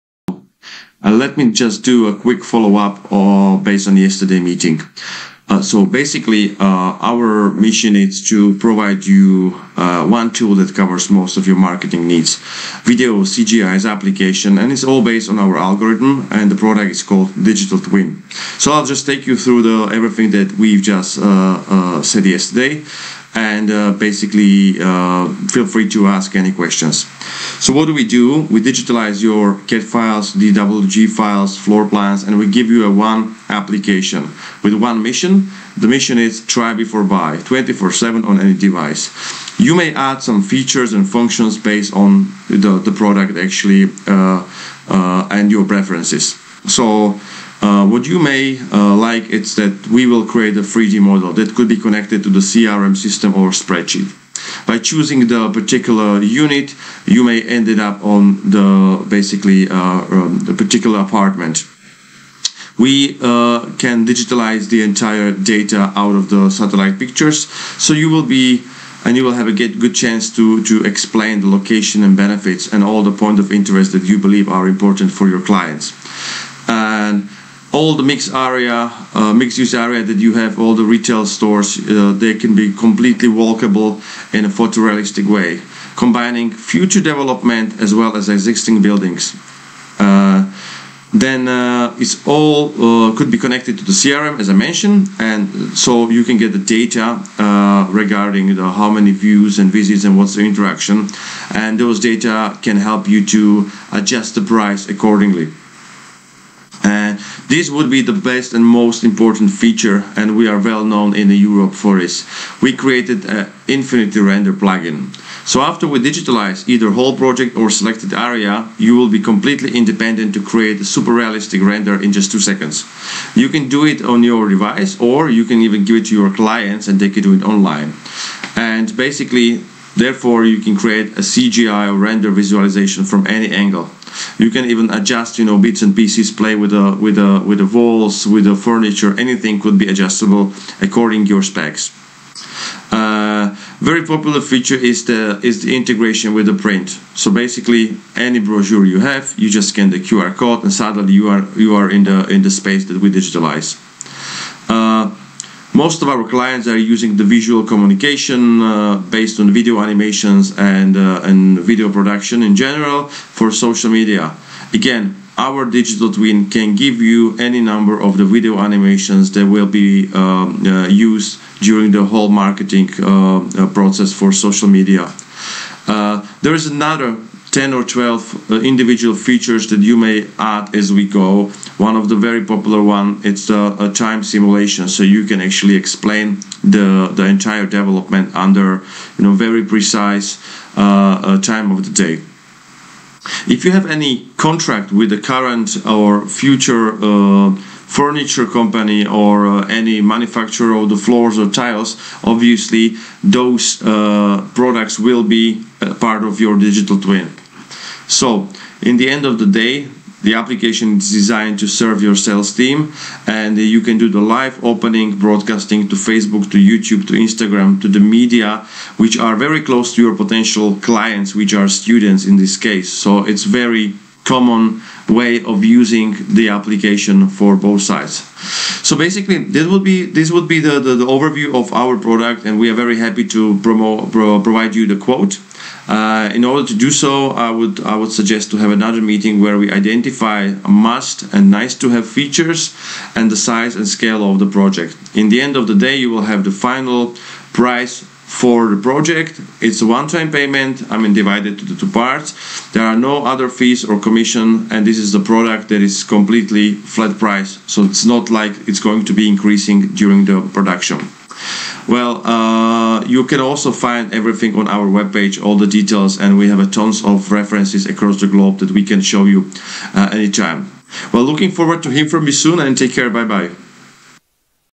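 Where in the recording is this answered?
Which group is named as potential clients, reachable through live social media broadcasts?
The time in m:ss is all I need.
3:41.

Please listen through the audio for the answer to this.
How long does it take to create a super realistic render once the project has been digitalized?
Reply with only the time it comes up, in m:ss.
2:02.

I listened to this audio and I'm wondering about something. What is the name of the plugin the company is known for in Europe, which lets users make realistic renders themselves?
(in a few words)
Infinity Render.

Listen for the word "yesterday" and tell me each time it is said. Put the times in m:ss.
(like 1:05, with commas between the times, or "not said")
0:03, 0:22.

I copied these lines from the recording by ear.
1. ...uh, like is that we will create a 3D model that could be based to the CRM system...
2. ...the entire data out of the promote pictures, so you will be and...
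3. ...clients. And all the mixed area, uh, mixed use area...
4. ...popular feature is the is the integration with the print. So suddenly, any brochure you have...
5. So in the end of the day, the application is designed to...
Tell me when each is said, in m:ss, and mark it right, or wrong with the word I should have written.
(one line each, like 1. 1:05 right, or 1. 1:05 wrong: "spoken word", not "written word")
1. 0:48 wrong: "connected", not "based"
2. 1:04 wrong: "satellite", not "promote"
3. 1:15 right
4. 2:24 wrong: "basically", not "suddenly"
5. 3:28 right.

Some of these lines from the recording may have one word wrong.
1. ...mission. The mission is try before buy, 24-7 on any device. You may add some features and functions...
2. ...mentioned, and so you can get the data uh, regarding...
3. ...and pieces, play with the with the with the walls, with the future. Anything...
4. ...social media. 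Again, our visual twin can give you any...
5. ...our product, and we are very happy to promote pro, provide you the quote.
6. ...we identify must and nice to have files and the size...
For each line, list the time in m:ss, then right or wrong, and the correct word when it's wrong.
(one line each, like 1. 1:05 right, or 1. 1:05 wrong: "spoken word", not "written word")
1. 0:35 right
2. 1:34 right
3. 2:15 wrong: "furniture", not "future"
4. 2:43 wrong: "digital", not "visual"
5. 3:51 right
6. 3:59 wrong: "features", not "files".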